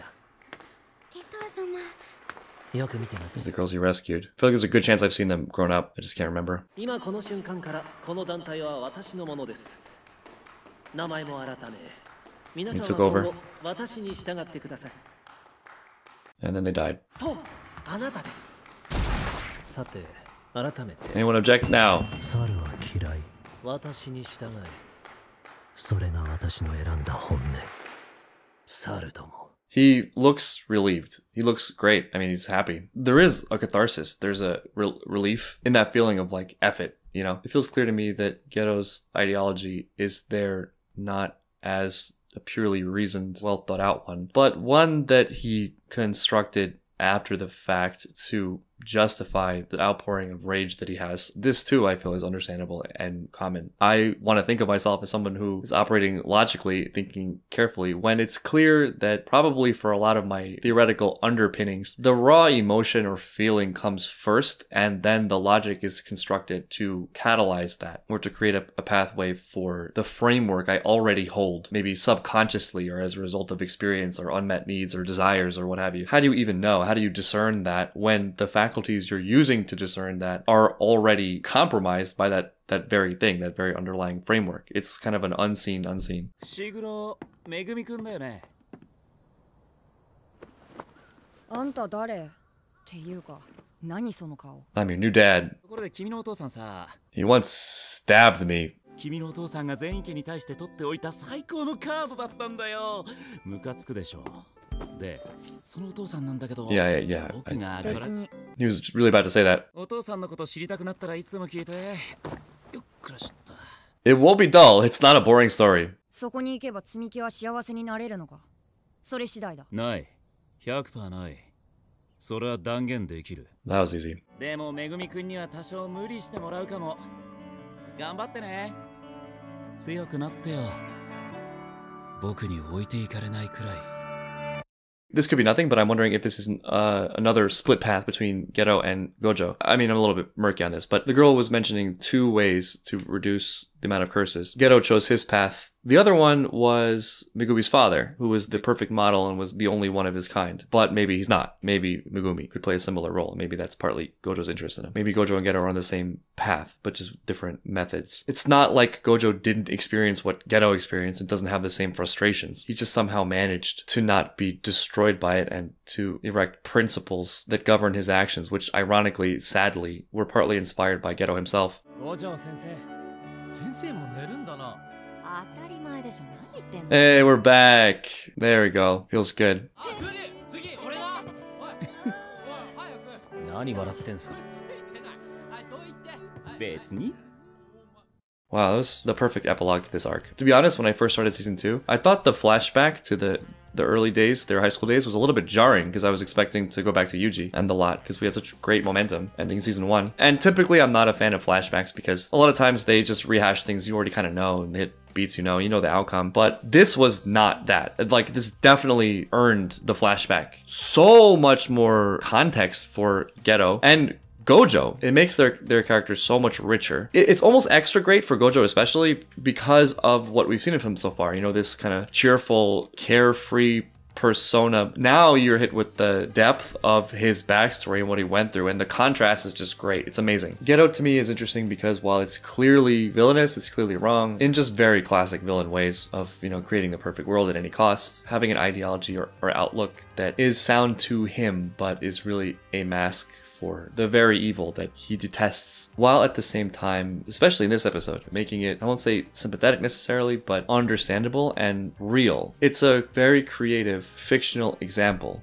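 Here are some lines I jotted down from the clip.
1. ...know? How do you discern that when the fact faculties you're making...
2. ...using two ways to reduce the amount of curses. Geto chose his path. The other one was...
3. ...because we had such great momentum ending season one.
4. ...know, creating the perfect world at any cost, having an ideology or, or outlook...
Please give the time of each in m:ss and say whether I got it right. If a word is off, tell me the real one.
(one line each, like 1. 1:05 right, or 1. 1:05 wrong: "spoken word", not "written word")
1. 1:16 wrong: "using", not "making"
2. 2:21 wrong: "mentioning", not "using"
3. 3:18 right
4. 3:56 right.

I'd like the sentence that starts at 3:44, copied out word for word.
Now you're hit with the depth of his backstory and what he went through, and the contrast is just great.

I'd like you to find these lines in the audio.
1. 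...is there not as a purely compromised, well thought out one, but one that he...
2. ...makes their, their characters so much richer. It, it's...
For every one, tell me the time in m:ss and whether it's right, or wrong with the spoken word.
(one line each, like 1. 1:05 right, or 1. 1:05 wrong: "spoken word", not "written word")
1. 0:39 wrong: "reasoned", not "compromised"
2. 3:35 right.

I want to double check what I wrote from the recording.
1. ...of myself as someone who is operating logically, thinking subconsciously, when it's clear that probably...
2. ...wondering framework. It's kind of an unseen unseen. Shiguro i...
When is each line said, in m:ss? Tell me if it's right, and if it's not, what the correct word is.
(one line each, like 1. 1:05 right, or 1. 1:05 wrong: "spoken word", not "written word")
1. 0:54 wrong: "carefully", not "subconsciously"
2. 1:23 wrong: "underlying", not "wondering".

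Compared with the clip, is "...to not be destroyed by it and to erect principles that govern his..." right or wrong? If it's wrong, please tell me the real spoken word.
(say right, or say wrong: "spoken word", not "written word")
right.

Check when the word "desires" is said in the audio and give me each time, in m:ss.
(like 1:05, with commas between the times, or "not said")
1:15.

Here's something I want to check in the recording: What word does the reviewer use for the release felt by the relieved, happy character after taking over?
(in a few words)
catharsis.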